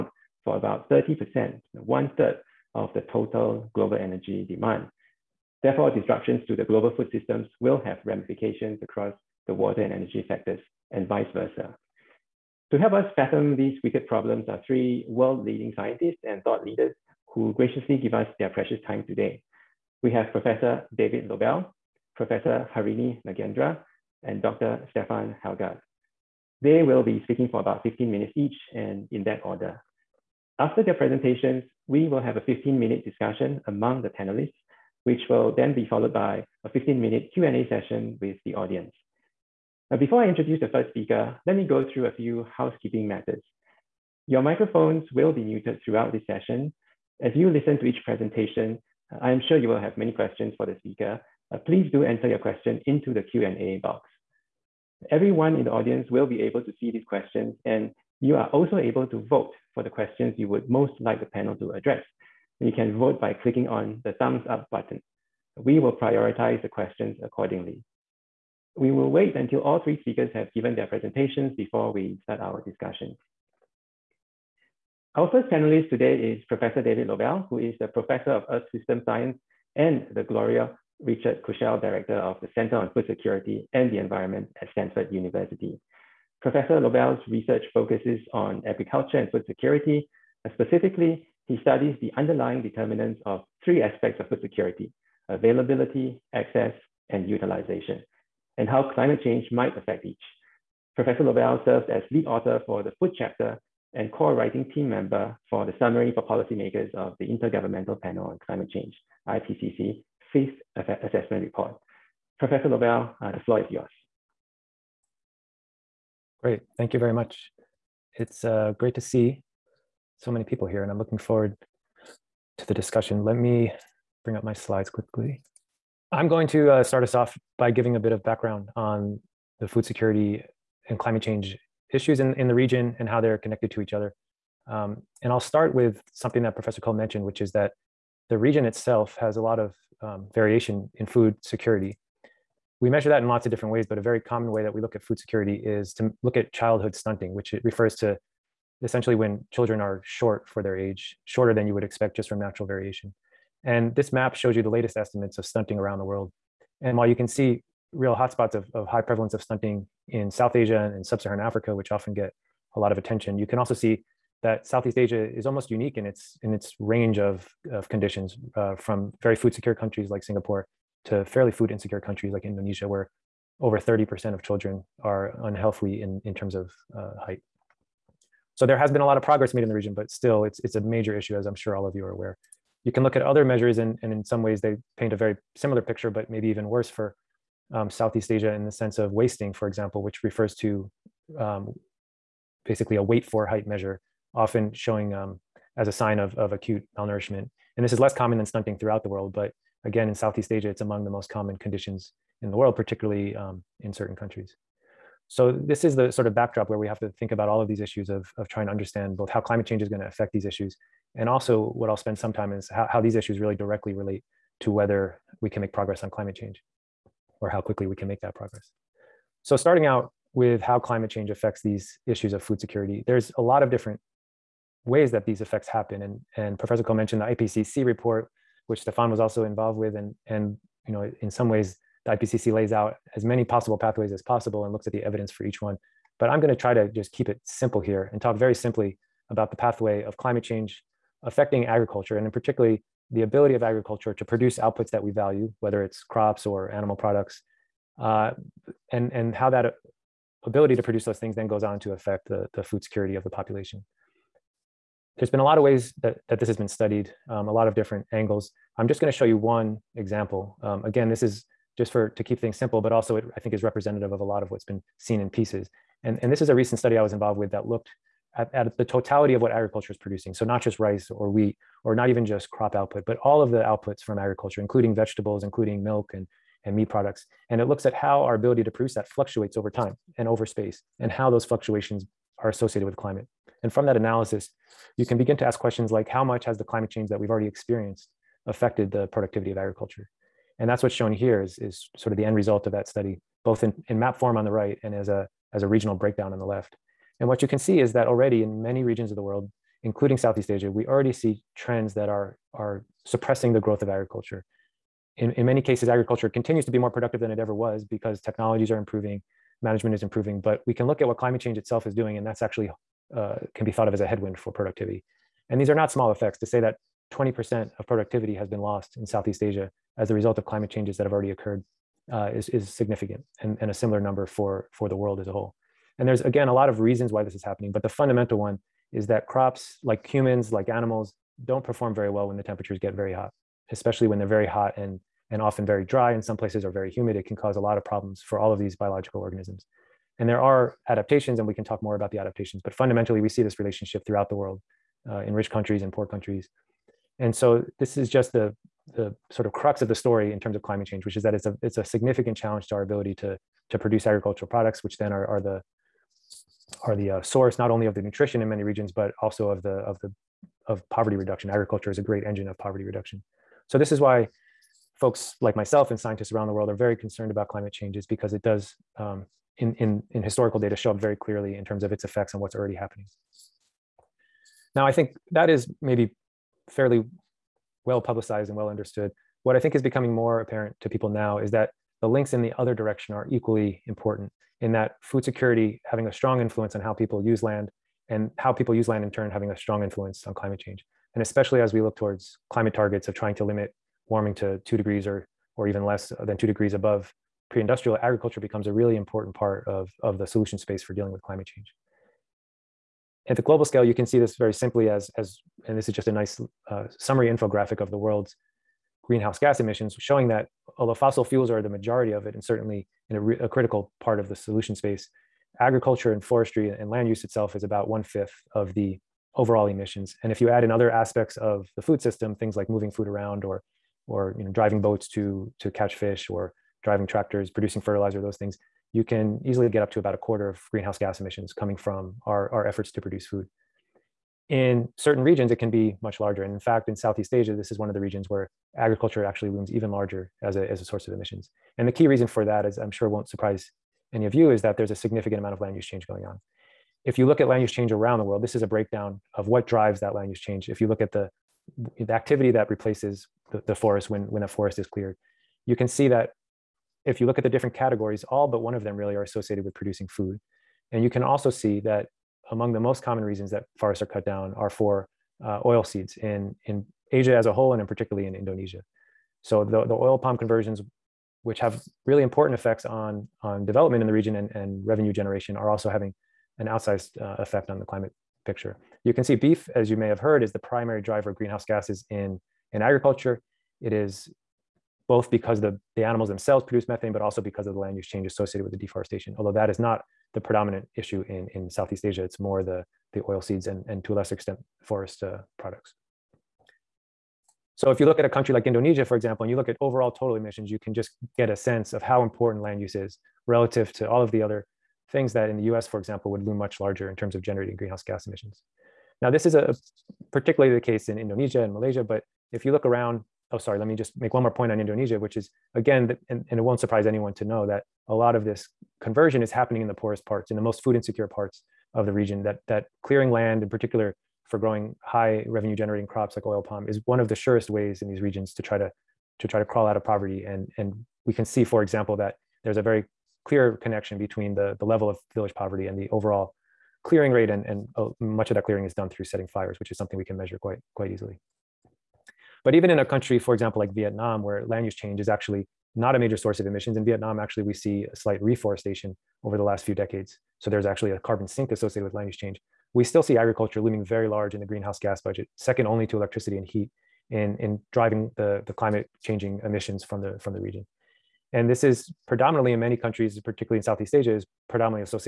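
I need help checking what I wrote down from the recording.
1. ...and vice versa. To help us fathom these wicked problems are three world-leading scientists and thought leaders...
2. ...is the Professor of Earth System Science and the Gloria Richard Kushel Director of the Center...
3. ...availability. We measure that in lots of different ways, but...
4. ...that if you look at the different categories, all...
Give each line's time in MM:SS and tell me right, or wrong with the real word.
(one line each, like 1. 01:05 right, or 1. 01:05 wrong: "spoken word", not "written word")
1. 00:10 right
2. 01:17 right
3. 02:21 wrong: "security", not "availability"
4. 07:36 right.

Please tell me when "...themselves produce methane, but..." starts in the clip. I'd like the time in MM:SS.
08:06.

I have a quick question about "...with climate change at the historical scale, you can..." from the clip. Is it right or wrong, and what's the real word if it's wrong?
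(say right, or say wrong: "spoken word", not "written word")
wrong: "global", not "historical".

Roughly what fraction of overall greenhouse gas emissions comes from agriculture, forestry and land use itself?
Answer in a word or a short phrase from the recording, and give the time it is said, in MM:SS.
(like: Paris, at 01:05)
one fifth, at 06:57.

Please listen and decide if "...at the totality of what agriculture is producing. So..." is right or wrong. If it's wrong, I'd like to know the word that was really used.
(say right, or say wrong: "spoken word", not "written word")
right.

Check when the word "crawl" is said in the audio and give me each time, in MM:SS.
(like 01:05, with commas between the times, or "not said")
08:49.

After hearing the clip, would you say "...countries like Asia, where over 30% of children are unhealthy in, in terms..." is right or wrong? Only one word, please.
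wrong.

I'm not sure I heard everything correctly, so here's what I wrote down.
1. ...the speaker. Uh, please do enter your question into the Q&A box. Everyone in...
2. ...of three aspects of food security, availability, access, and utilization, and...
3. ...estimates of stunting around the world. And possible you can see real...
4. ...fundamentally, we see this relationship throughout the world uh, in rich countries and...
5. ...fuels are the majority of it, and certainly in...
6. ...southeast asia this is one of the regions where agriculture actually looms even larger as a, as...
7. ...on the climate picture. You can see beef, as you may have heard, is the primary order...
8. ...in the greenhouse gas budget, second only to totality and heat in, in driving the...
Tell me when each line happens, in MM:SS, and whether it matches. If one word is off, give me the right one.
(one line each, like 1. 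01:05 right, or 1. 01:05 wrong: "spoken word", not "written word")
1. 00:50 right
2. 01:33 right
3. 02:34 wrong: "while", not "possible"
4. 05:42 right
5. 06:51 right
6. 07:16 right
7. 07:57 wrong: "driver", not "order"
8. 09:14 wrong: "electricity", not "totality".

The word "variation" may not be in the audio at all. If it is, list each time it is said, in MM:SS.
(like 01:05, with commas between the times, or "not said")
02:20, 02:32.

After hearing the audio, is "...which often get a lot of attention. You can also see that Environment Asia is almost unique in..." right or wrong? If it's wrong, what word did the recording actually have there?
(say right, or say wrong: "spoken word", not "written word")
wrong: "Southeast", not "Environment".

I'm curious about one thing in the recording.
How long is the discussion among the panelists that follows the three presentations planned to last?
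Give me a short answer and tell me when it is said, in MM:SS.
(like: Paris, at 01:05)
15 minutes, at 00:32.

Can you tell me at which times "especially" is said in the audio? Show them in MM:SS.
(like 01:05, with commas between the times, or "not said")
05:33, 06:31.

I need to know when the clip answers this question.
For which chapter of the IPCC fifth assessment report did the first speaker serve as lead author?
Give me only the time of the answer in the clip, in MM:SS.
01:42.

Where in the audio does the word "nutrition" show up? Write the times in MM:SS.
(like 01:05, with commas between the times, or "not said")
05:58.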